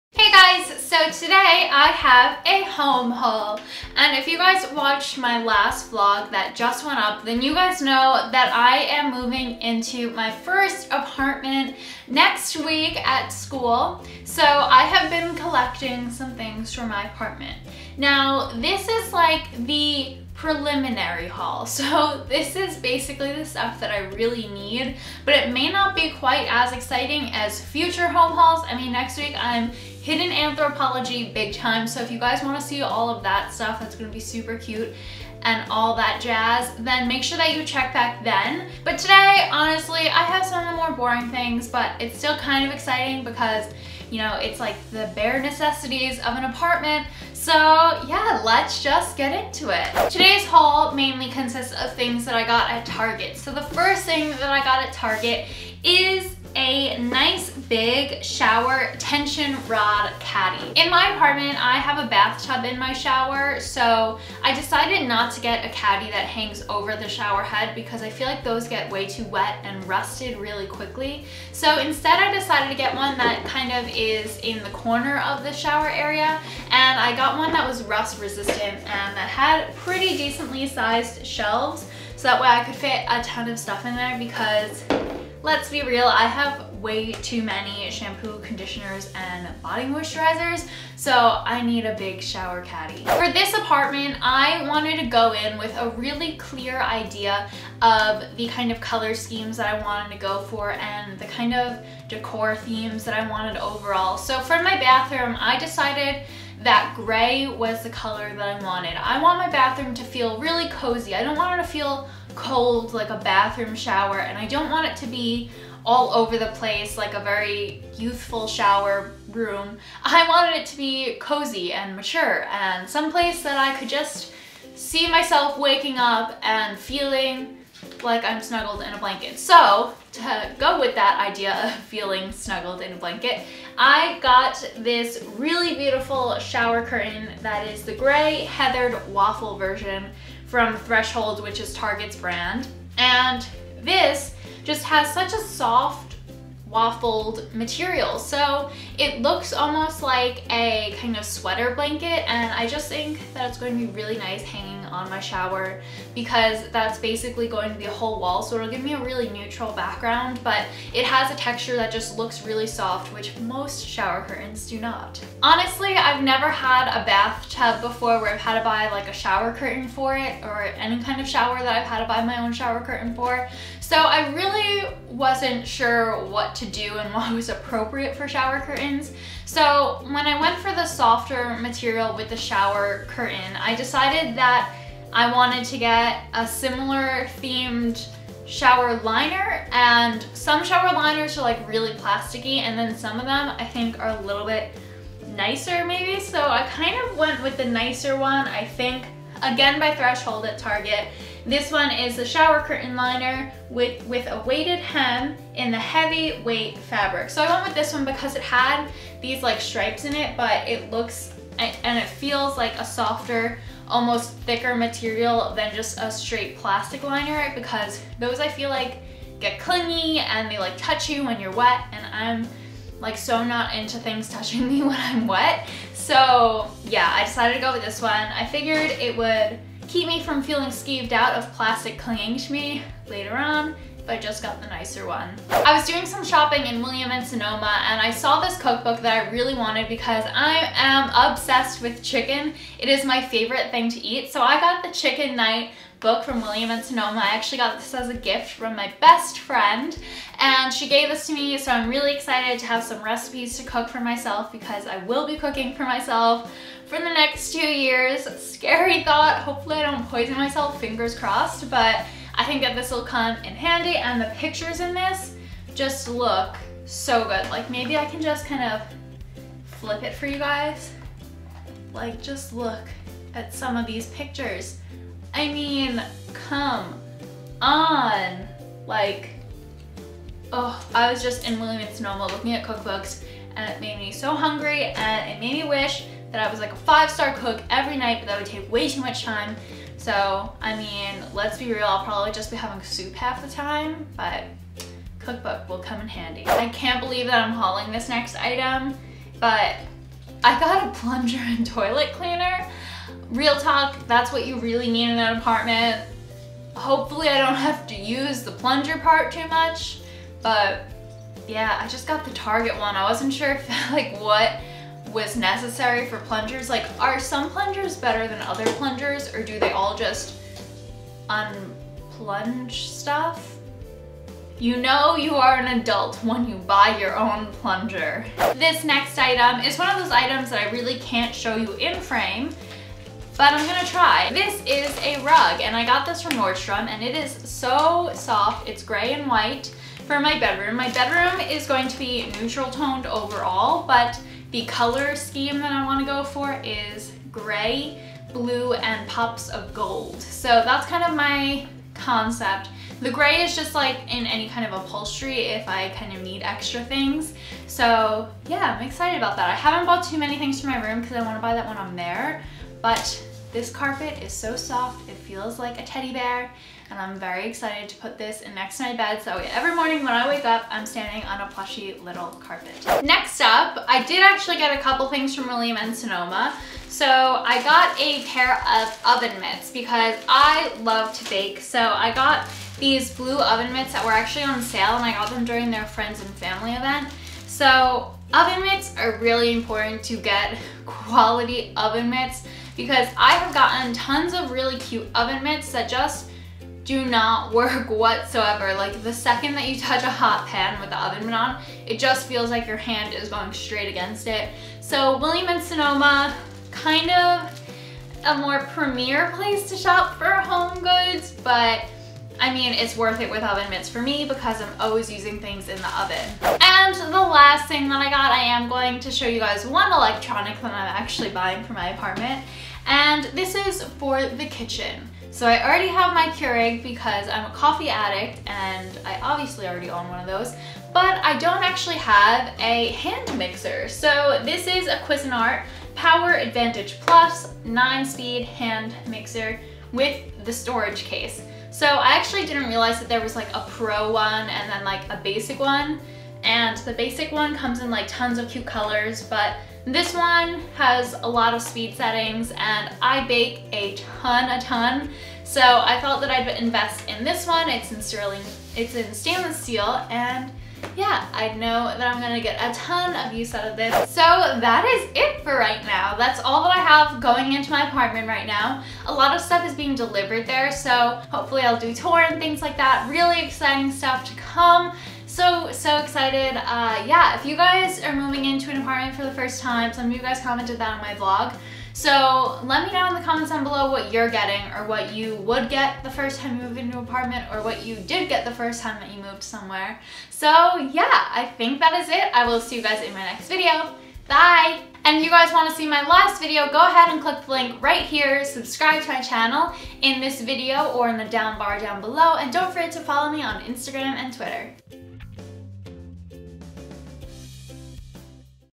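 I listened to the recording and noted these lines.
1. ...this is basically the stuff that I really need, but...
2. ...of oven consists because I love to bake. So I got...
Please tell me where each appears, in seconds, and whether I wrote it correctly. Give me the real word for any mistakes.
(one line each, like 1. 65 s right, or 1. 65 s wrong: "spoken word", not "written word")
1. 22 s right
2. 378 s wrong: "mitts", not "consists".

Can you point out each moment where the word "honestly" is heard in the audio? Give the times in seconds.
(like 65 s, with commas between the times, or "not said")
39 s, 165 s.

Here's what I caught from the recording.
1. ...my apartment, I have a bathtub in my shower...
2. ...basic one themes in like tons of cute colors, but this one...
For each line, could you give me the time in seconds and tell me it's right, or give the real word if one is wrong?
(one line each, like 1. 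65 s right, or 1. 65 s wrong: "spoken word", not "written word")
1. 60 s right
2. 446 s wrong: "comes", not "themes".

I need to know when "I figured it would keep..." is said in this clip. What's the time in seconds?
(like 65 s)
228 s.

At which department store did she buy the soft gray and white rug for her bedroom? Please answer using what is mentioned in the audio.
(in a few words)
Nordstrom.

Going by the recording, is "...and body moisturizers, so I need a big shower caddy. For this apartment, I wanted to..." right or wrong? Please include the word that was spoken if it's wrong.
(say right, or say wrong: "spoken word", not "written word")
right.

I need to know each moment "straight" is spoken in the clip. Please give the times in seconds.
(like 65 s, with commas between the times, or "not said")
216 s, 403 s.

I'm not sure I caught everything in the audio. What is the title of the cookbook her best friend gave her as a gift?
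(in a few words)
Chicken Night.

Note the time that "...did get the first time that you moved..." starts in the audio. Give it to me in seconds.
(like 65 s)
487 s.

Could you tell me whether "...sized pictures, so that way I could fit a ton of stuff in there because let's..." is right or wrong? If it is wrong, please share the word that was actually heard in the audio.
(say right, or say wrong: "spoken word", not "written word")
wrong: "shelves", not "pictures".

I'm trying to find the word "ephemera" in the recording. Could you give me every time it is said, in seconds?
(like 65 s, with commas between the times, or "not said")
not said.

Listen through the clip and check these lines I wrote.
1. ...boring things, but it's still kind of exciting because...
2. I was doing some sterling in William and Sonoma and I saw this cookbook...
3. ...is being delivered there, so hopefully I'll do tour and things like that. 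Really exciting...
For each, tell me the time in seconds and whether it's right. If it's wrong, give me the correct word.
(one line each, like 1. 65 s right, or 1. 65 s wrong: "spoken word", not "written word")
1. 40 s right
2. 235 s wrong: "shopping", not "sterling"
3. 469 s right.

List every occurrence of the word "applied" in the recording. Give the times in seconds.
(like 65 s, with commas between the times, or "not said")
not said.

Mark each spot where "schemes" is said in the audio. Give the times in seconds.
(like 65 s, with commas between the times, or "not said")
99 s, 345 s.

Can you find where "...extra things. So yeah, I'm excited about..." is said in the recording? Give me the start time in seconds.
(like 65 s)
356 s.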